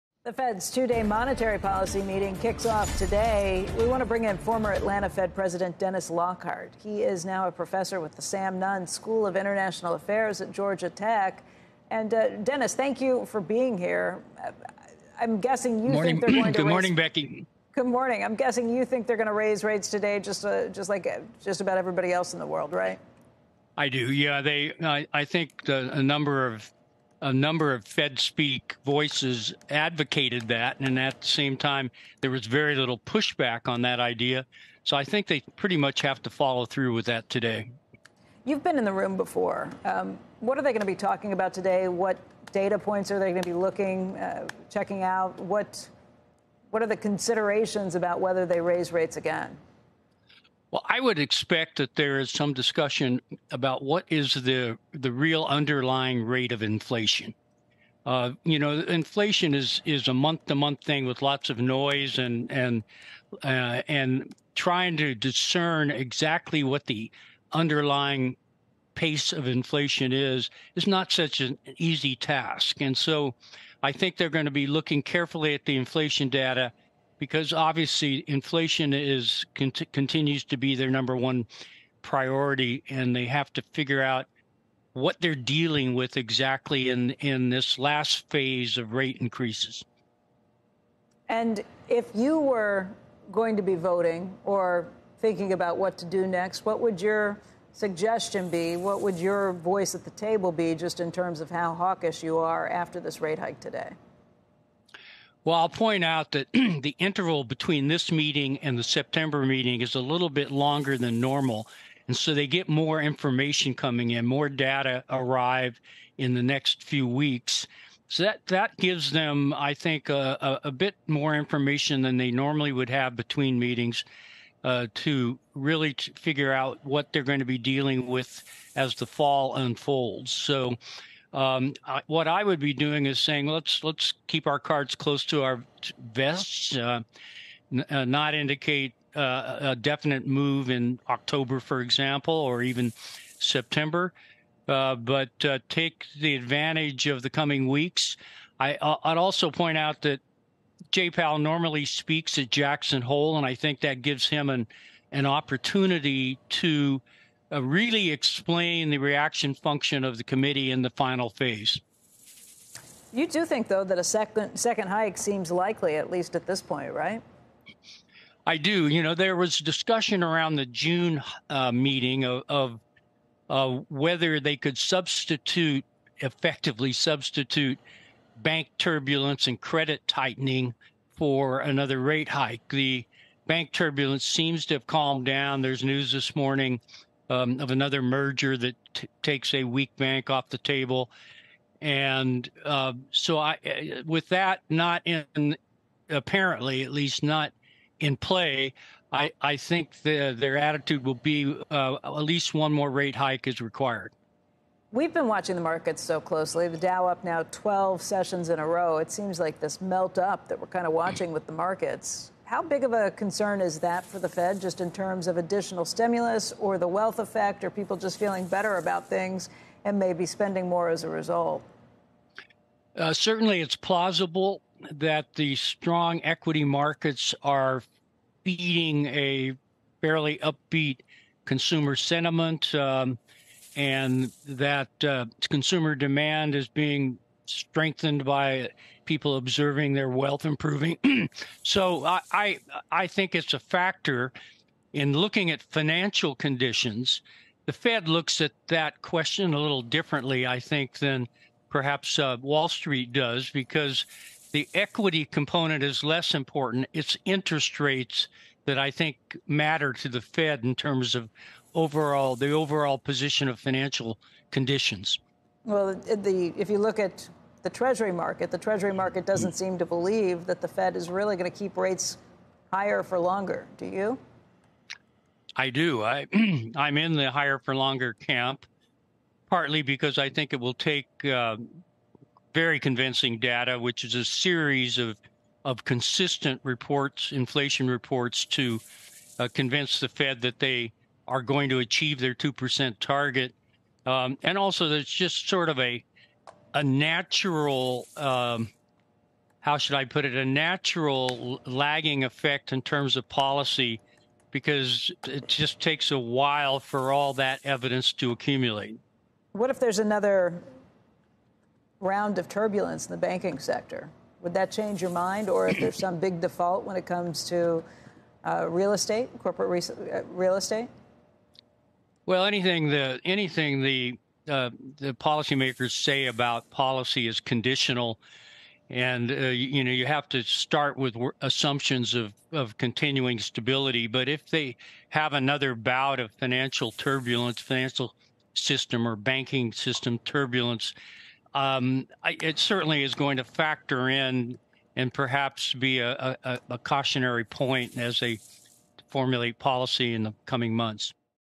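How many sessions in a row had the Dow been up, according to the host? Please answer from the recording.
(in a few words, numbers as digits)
12.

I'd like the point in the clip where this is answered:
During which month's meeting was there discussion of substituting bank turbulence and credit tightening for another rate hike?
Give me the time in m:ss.
2:50.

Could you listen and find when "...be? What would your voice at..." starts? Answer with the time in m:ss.
1:38.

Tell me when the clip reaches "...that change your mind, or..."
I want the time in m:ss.
5:14.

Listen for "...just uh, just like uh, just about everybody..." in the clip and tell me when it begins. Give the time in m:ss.
0:20.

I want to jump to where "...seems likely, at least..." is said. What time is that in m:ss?
2:45.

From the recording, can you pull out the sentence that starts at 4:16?
It's interest rates that I think matter to the Fed in terms of overall the overall position of financial conditions.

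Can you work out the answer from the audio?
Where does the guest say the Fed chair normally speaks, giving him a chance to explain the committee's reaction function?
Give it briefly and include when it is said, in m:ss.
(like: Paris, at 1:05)
Jackson Hole, at 2:32.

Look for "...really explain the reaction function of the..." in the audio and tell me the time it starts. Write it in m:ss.
2:37.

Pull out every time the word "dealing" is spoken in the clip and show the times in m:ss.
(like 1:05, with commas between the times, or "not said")
1:25, 2:07.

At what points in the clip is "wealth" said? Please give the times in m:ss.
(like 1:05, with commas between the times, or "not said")
3:36, 4:00.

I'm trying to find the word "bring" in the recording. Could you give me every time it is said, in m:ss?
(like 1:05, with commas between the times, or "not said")
0:04.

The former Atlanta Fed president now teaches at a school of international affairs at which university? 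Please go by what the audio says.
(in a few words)
Georgia Tech.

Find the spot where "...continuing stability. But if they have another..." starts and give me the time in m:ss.
5:32.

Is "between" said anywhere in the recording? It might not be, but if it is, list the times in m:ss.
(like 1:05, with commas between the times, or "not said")
1:47, 2:03.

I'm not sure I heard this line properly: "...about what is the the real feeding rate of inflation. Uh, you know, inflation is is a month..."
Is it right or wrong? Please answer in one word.
wrong.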